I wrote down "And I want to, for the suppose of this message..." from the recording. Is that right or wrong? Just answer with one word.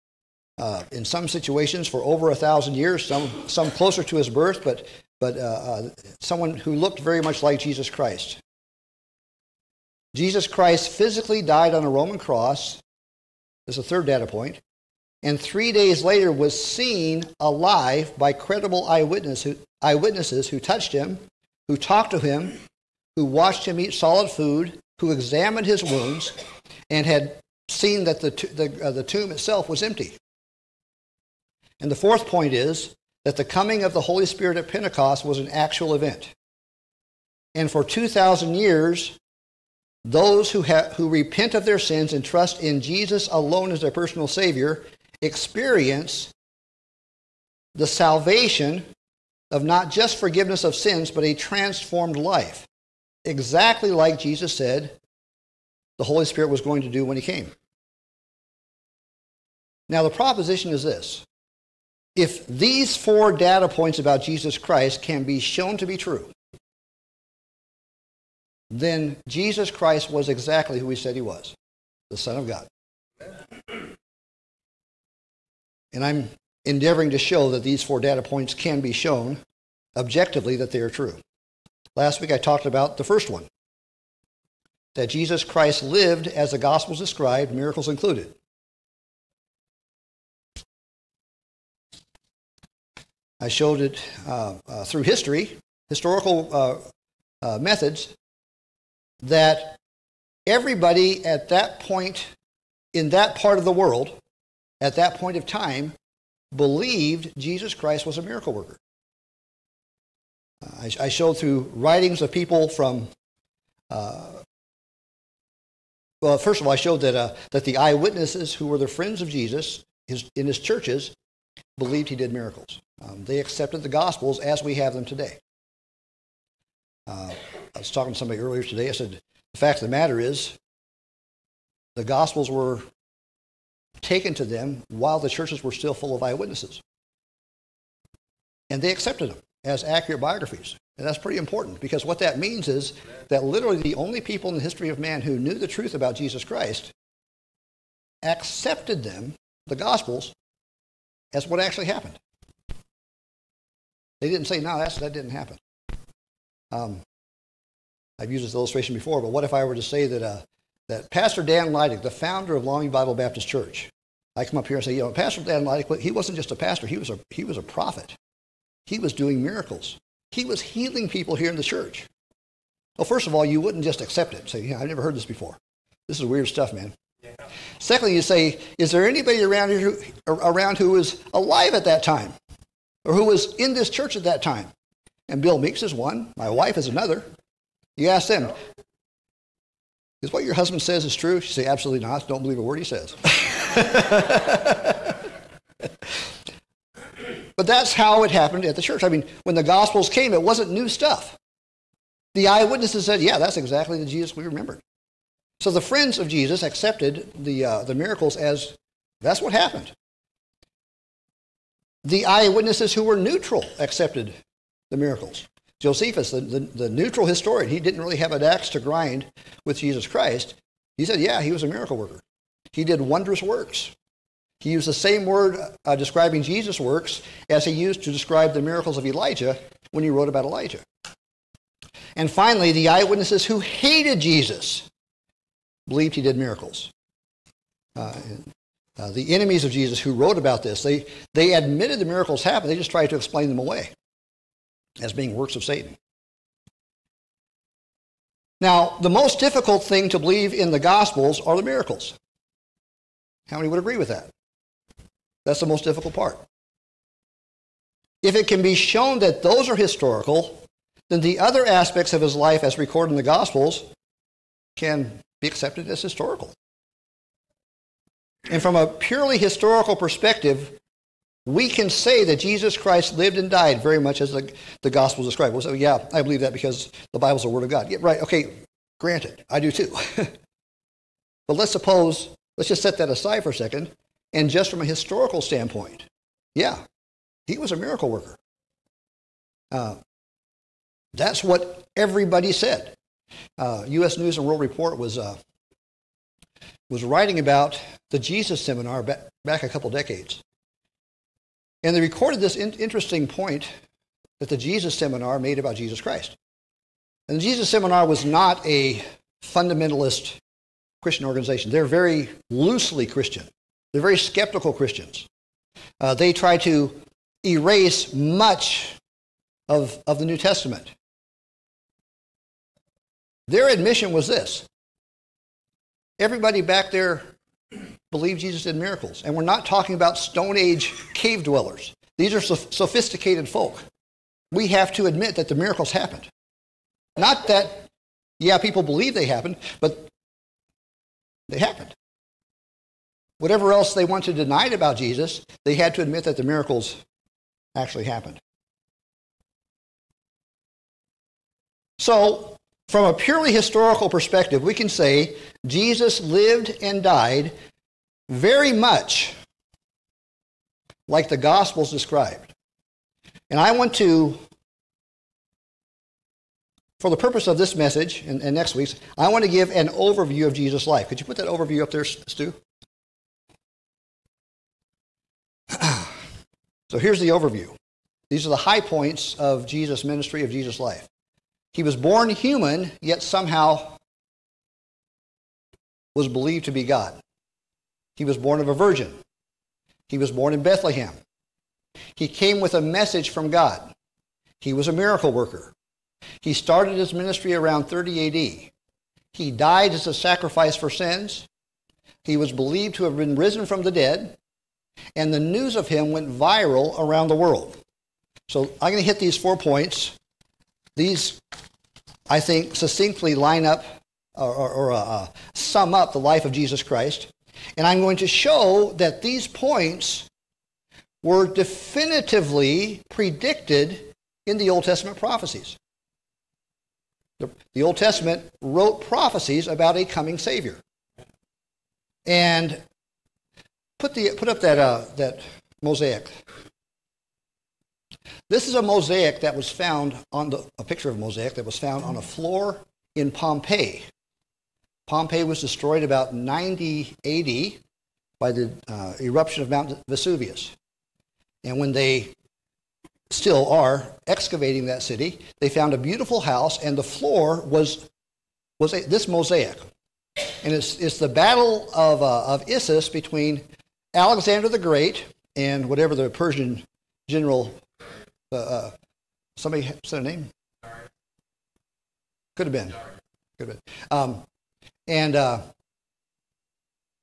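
wrong.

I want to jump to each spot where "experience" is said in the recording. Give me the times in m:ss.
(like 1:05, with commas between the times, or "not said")
0:45.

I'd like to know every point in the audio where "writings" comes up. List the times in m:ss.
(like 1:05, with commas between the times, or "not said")
1:51, 4:57.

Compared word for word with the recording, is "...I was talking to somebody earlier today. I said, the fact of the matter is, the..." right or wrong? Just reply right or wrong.
right.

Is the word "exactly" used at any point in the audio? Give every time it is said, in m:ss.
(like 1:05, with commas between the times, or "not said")
0:53, 1:10, 3:23.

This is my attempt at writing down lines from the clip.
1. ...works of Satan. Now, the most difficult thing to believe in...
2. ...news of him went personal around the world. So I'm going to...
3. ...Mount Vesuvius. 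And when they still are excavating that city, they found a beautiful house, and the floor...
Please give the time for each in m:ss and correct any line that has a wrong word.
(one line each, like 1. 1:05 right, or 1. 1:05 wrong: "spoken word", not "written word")
1. 4:05 right
2. 6:45 wrong: "viral", not "personal"
3. 7:29 right.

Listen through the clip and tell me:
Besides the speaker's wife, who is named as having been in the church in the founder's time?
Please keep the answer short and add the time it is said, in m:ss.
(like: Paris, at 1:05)
Bill Meeks, at 3:05.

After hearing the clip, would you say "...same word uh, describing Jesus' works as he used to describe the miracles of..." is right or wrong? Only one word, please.
right.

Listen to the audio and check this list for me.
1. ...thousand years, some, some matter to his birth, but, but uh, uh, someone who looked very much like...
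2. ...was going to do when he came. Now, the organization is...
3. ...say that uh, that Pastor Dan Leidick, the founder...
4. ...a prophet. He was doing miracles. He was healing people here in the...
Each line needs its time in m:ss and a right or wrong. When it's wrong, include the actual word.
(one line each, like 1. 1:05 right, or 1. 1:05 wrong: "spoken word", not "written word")
1. 0:02 wrong: "closer", not "matter"
2. 0:56 wrong: "proposition", not "organization"
3. 2:39 right
4. 2:47 right.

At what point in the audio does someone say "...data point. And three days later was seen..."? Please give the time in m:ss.
0:14.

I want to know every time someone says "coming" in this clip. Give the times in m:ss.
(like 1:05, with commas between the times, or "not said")
0:33, 7:10.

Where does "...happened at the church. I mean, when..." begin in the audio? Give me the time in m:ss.
3:18.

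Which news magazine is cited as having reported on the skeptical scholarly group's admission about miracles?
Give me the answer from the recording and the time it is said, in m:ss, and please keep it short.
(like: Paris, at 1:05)
U.S. News and World Report, at 4:53.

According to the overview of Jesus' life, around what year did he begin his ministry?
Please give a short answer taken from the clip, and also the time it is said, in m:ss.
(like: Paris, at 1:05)
30 AD, at 6:37.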